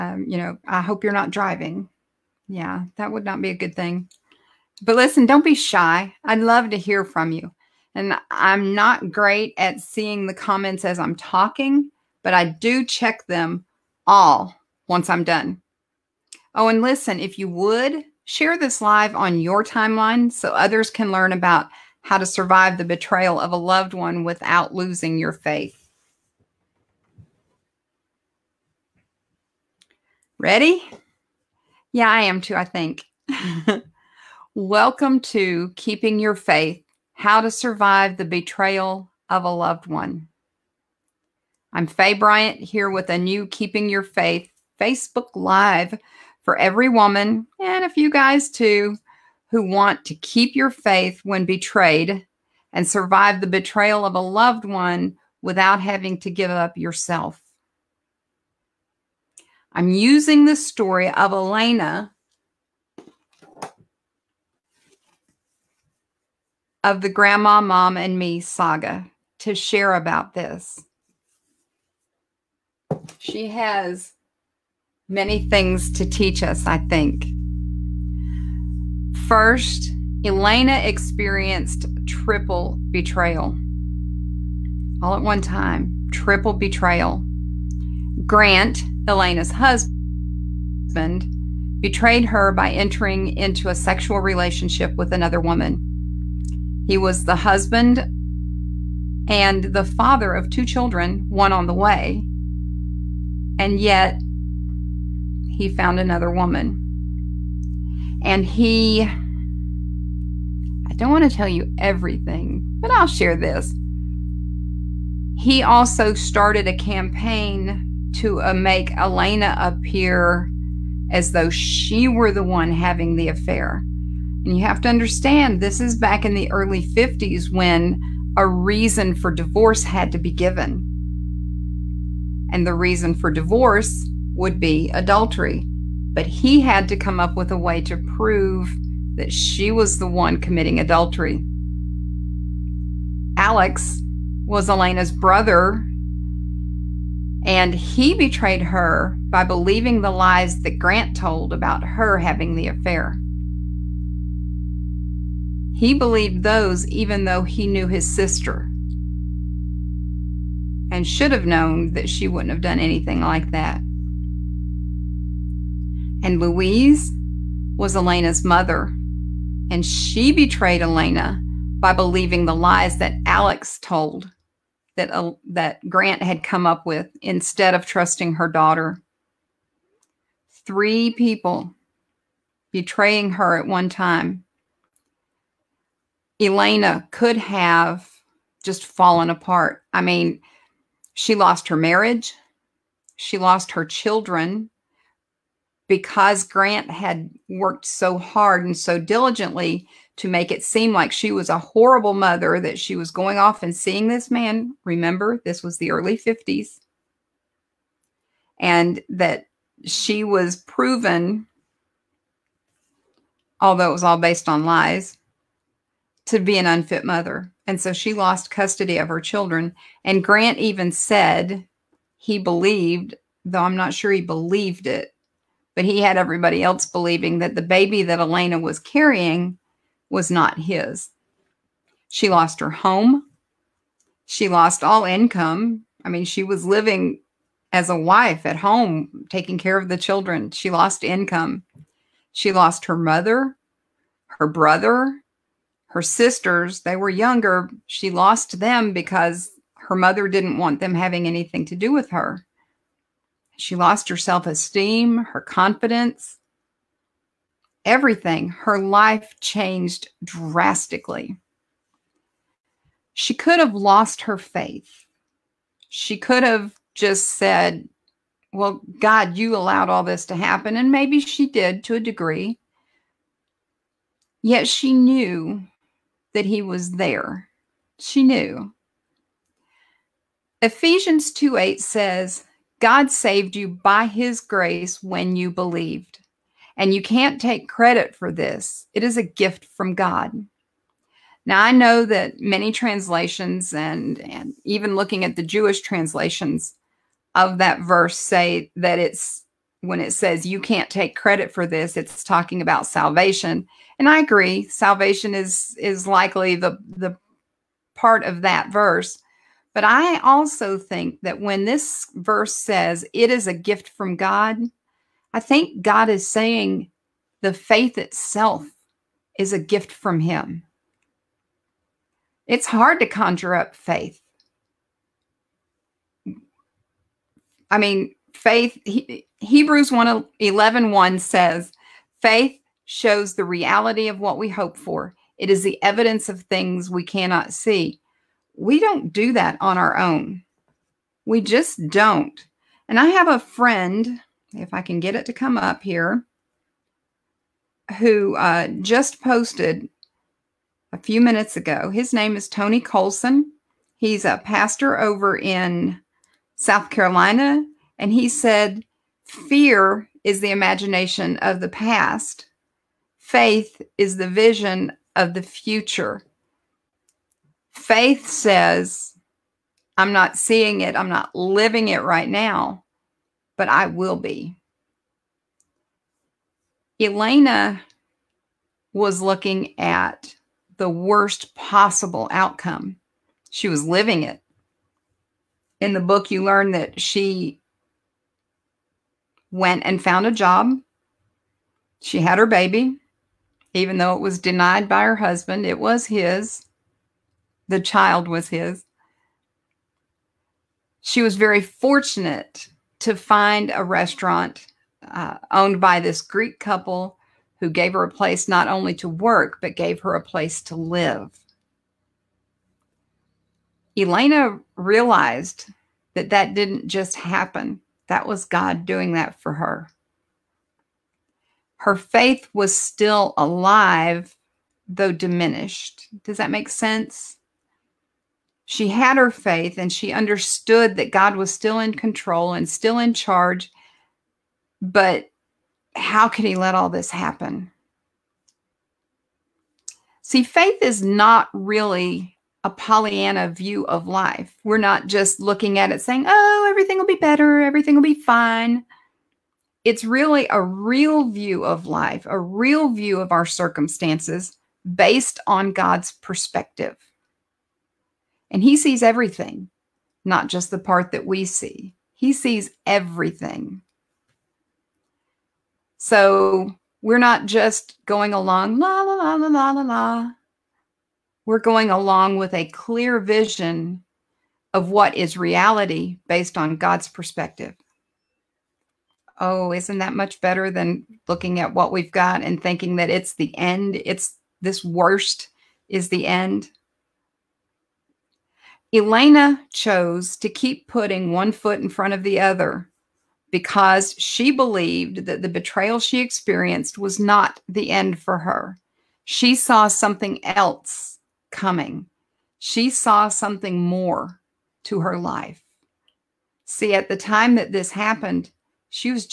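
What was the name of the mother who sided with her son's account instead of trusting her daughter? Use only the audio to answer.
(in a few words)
Louise.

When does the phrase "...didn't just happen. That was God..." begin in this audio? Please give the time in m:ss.
6:56.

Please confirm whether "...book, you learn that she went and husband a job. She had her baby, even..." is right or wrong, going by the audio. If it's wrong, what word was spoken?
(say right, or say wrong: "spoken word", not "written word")
wrong: "found", not "husband".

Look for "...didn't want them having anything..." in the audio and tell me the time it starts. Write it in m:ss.
4:10.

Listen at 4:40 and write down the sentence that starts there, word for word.
Ephesians 2 8 says, God saved you by his grace when you believed.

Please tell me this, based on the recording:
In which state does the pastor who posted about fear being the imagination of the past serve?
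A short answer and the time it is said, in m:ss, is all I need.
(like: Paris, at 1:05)
South Carolina, at 5:56.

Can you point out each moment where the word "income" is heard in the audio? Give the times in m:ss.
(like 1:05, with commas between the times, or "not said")
3:55, 4:01.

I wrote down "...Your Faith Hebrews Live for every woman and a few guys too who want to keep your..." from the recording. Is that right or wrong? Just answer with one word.
wrong.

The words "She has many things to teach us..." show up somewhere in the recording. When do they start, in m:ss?
1:13.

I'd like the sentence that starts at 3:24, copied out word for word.
Remember, this was the early 50s.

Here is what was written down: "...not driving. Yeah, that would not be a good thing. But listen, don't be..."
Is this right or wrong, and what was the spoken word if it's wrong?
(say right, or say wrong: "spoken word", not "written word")
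right.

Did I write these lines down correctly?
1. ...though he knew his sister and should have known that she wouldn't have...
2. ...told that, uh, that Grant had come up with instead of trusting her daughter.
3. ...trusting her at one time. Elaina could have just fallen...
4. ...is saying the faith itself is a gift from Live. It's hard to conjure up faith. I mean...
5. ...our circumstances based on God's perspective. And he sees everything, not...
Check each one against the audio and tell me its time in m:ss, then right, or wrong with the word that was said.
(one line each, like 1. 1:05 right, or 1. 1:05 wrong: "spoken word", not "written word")
1. 2:37 right
2. 2:53 right
3. 3:02 wrong: "betraying", not "trusting"
4. 5:16 wrong: "Him", not "Live"
5. 7:33 right.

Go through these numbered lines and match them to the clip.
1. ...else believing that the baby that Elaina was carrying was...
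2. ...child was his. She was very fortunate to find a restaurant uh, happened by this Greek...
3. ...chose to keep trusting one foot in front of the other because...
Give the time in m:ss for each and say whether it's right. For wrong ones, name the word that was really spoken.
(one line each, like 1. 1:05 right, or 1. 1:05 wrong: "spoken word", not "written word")
1. 3:46 right
2. 6:37 wrong: "owned", not "happened"
3. 8:09 wrong: "putting", not "trusting".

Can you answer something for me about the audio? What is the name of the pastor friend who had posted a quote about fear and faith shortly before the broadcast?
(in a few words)
Tony Colson.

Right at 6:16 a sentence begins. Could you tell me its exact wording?
Elaina was looking at the worst possible outcome.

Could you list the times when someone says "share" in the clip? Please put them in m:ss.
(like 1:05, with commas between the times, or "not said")
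0:18, 1:09, 1:53.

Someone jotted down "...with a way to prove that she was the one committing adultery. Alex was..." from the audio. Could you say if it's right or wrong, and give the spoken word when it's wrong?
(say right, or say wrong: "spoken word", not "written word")
right.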